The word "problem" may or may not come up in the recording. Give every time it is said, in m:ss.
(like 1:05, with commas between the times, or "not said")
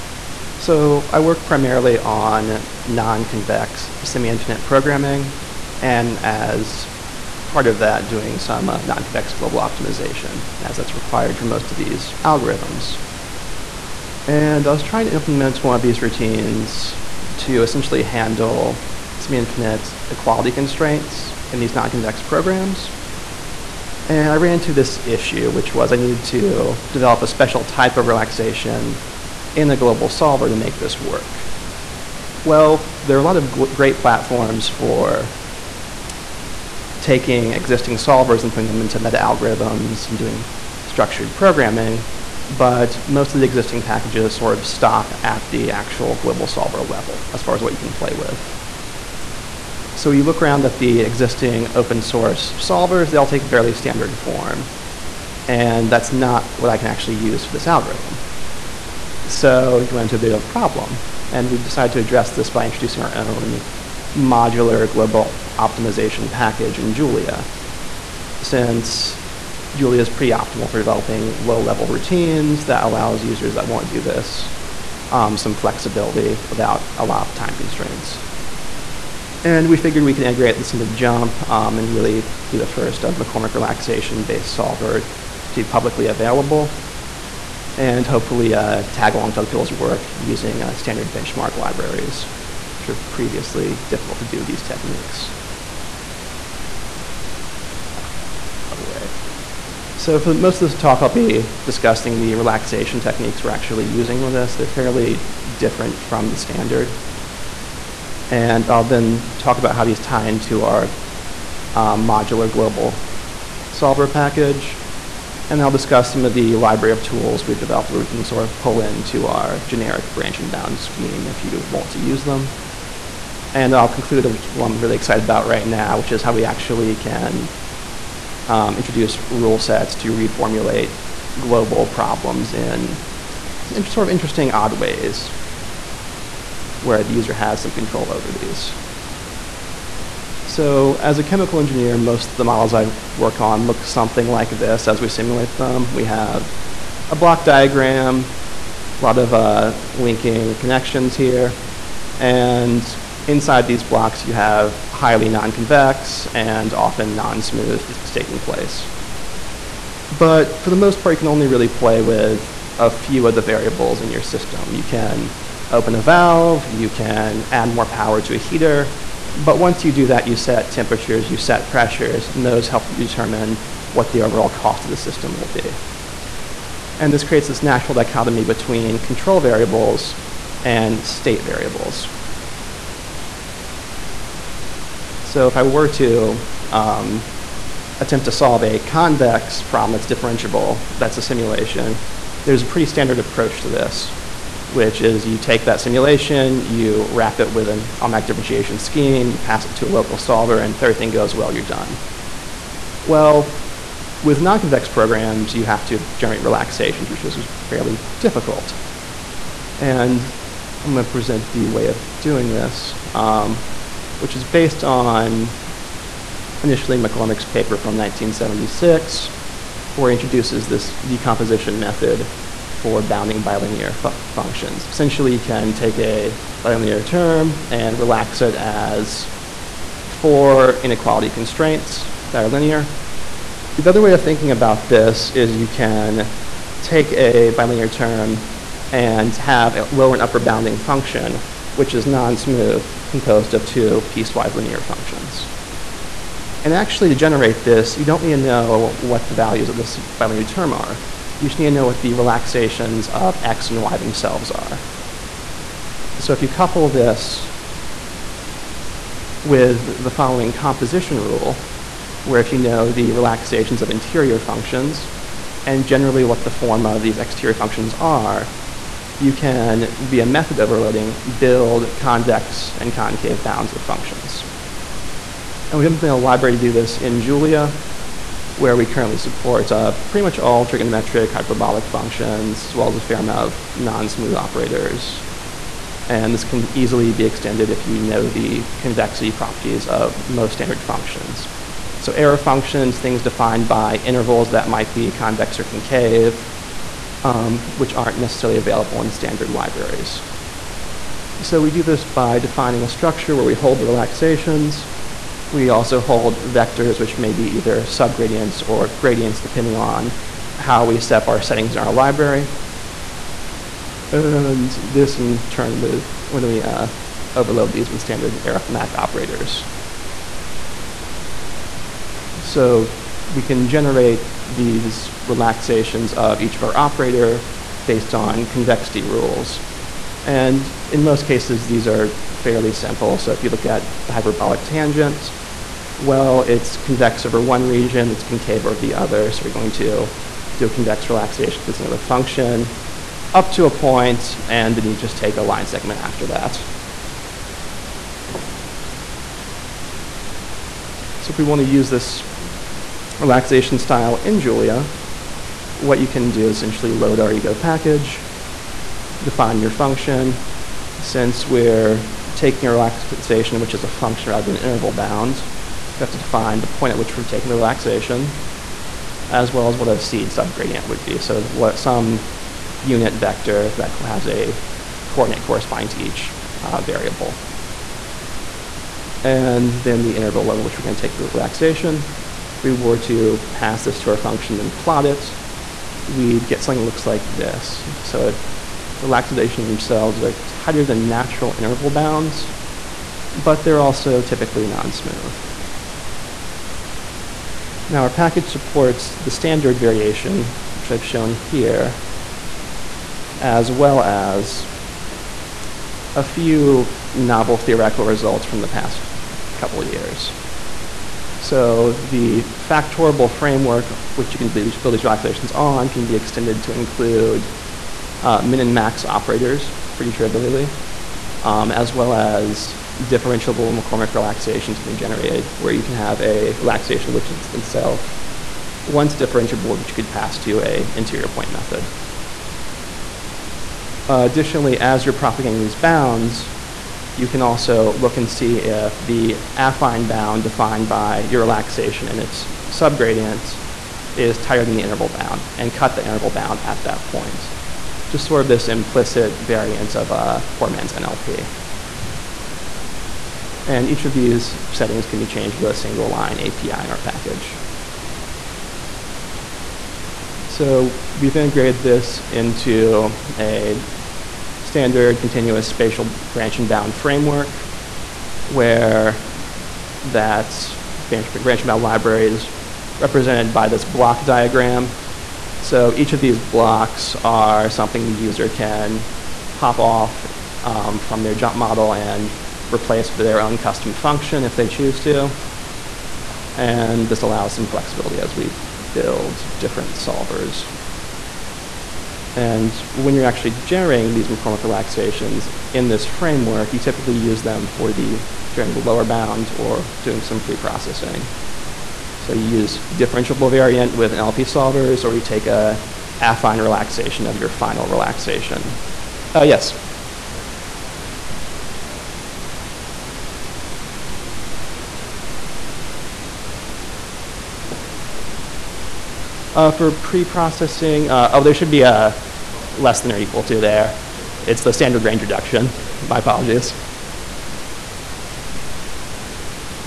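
1:00, 2:11, 3:09.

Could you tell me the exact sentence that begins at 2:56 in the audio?
And this creates this natural dichotomy between control variables and state variables.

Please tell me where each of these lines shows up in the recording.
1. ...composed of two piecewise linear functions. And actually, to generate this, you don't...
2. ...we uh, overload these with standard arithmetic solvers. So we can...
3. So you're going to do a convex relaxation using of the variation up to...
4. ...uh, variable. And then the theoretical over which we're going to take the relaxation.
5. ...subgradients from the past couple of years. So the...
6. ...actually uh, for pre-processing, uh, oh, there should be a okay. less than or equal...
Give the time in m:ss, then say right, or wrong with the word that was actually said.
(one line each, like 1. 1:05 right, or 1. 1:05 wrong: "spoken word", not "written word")
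1. 4:03 right
2. 5:16 wrong: "operators", not "solvers"
3. 5:39 wrong: "function", not "variation"
4. 6:16 wrong: "interval", not "theoretical"
5. 6:48 wrong: "results", not "subgradients"
6. 8:37 right.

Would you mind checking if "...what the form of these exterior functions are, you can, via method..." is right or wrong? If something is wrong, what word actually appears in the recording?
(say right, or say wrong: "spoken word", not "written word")
right.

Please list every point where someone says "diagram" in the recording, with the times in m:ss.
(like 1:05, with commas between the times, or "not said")
2:27, 7:54.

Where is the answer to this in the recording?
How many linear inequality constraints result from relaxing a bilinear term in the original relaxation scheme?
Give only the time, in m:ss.
3:50.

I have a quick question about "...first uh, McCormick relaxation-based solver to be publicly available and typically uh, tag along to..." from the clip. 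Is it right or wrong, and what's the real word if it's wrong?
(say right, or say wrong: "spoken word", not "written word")
wrong: "hopefully", not "typically".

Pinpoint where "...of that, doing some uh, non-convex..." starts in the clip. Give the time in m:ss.
0:07.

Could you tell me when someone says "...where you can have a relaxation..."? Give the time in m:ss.
7:05.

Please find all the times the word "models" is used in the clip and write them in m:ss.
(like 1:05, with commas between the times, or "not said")
2:22, 8:01.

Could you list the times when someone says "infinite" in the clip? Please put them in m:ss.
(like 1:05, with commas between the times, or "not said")
0:04, 0:19.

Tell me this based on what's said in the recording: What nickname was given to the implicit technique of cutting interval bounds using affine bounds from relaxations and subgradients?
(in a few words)
poor man's NLP.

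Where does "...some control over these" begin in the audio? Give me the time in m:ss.
2:17.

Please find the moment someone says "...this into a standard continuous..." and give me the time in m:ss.
7:41.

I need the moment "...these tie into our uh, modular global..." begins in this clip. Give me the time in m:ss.
1:49.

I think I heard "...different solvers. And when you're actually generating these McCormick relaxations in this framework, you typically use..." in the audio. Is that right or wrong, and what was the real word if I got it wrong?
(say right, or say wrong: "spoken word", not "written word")
right.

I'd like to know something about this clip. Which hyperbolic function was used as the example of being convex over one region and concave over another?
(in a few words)
hyperbolic tangent.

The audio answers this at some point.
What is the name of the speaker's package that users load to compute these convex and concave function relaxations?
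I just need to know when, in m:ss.
5:57.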